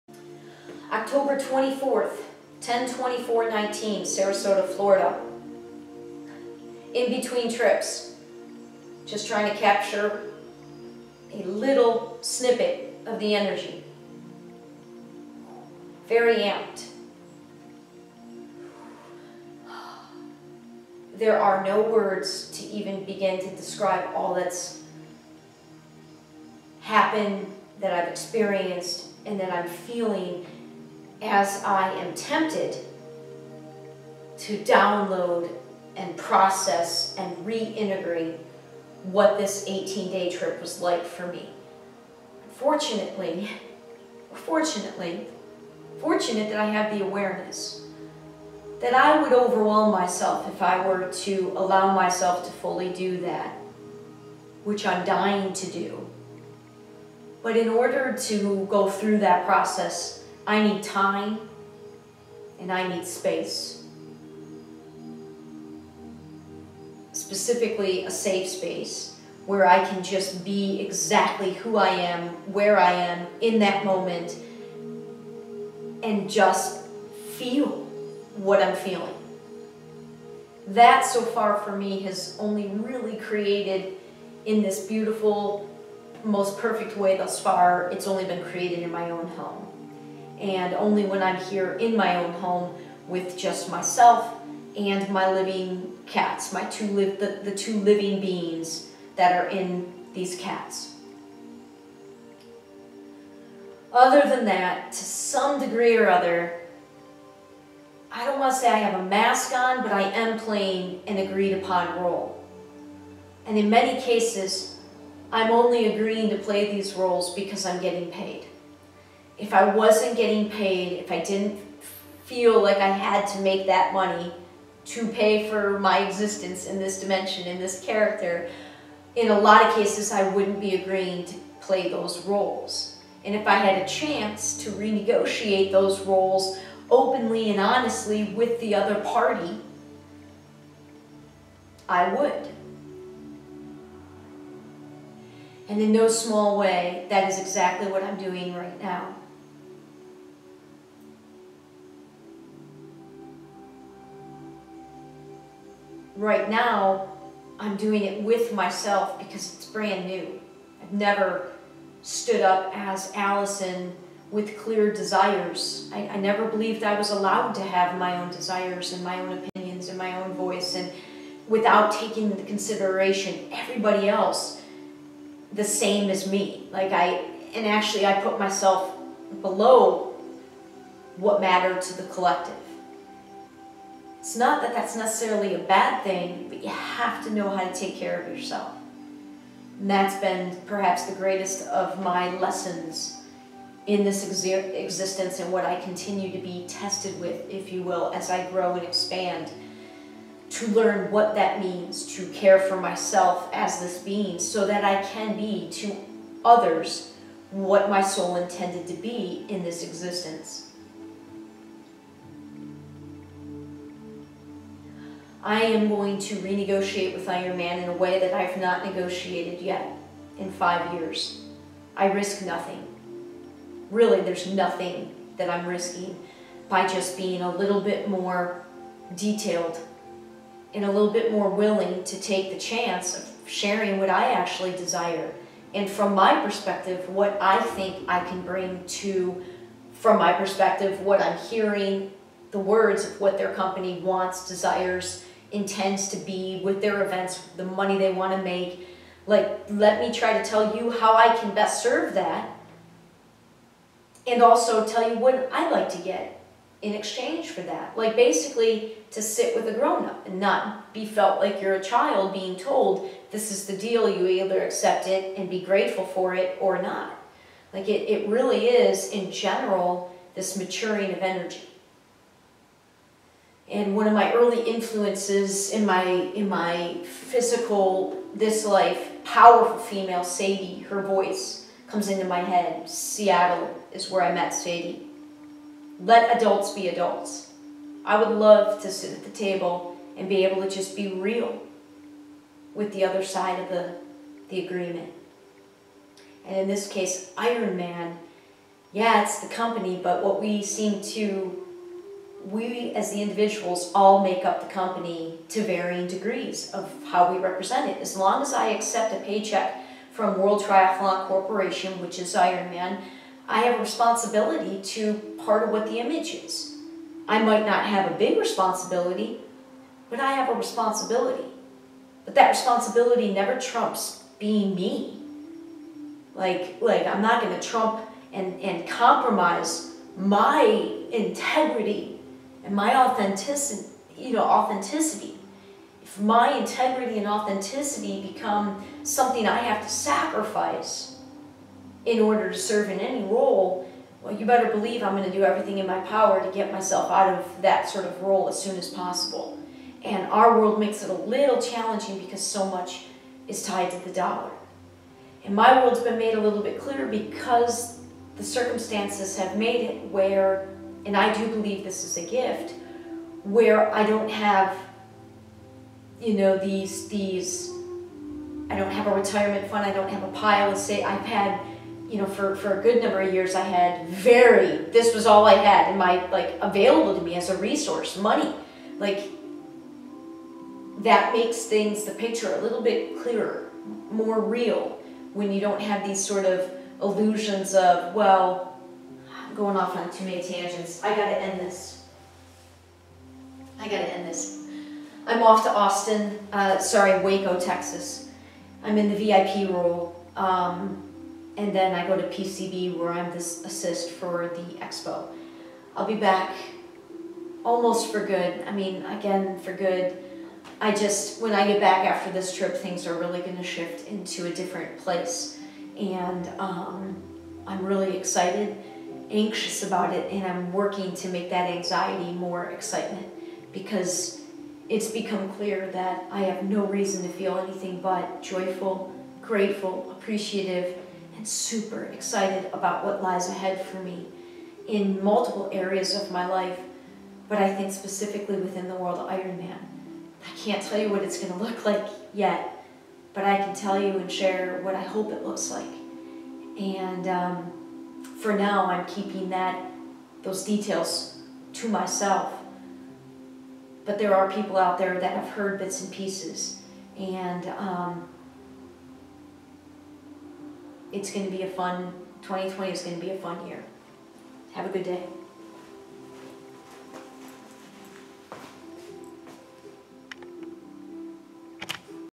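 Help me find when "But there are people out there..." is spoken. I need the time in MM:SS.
07:34.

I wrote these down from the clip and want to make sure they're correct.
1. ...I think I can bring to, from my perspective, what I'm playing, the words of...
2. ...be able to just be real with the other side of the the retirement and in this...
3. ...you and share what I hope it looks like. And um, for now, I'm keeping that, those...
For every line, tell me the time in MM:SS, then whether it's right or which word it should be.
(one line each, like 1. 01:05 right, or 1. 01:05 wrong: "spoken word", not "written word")
1. 03:57 wrong: "hearing", not "playing"
2. 04:50 wrong: "agreement", not "retirement"
3. 07:24 right.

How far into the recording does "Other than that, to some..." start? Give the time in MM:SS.
01:43.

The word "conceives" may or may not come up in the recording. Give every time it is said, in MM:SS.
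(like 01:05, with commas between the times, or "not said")
not said.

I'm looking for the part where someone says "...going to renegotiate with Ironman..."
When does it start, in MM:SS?
03:35.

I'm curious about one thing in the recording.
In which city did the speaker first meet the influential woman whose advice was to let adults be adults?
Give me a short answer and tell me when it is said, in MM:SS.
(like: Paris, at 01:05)
Seattle, at 04:42.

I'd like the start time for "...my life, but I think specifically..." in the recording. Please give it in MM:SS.
07:16.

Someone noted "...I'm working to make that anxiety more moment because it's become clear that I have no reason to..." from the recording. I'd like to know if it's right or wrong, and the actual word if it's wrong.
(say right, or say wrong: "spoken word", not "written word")
wrong: "excitement", not "moment".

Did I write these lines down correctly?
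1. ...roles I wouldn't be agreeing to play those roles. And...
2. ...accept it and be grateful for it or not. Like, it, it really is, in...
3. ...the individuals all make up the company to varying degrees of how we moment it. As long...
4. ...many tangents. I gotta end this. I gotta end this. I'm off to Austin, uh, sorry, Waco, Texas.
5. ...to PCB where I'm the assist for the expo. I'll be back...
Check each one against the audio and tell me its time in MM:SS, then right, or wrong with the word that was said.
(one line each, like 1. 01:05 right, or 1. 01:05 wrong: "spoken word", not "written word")
1. 02:09 wrong: "cases", not "roles"
2. 04:24 right
3. 05:03 wrong: "represent", not "moment"
4. 06:30 right
5. 06:42 right.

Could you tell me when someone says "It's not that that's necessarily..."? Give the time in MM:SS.
03:04.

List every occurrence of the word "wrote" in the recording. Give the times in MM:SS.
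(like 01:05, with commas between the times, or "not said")
not said.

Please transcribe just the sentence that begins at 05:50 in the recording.
And our world makes it a little challenging because so much is tied to the dollar.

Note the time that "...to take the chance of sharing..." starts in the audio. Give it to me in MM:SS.
03:52.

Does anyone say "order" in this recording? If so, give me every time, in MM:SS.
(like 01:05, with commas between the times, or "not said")
00:57, 05:42.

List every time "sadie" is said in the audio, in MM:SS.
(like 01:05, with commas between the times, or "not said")
04:40, 04:44.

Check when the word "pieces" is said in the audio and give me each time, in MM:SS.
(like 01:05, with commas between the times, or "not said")
07:36.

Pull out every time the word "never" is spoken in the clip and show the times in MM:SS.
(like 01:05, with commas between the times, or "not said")
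02:40, 02:46, 05:23.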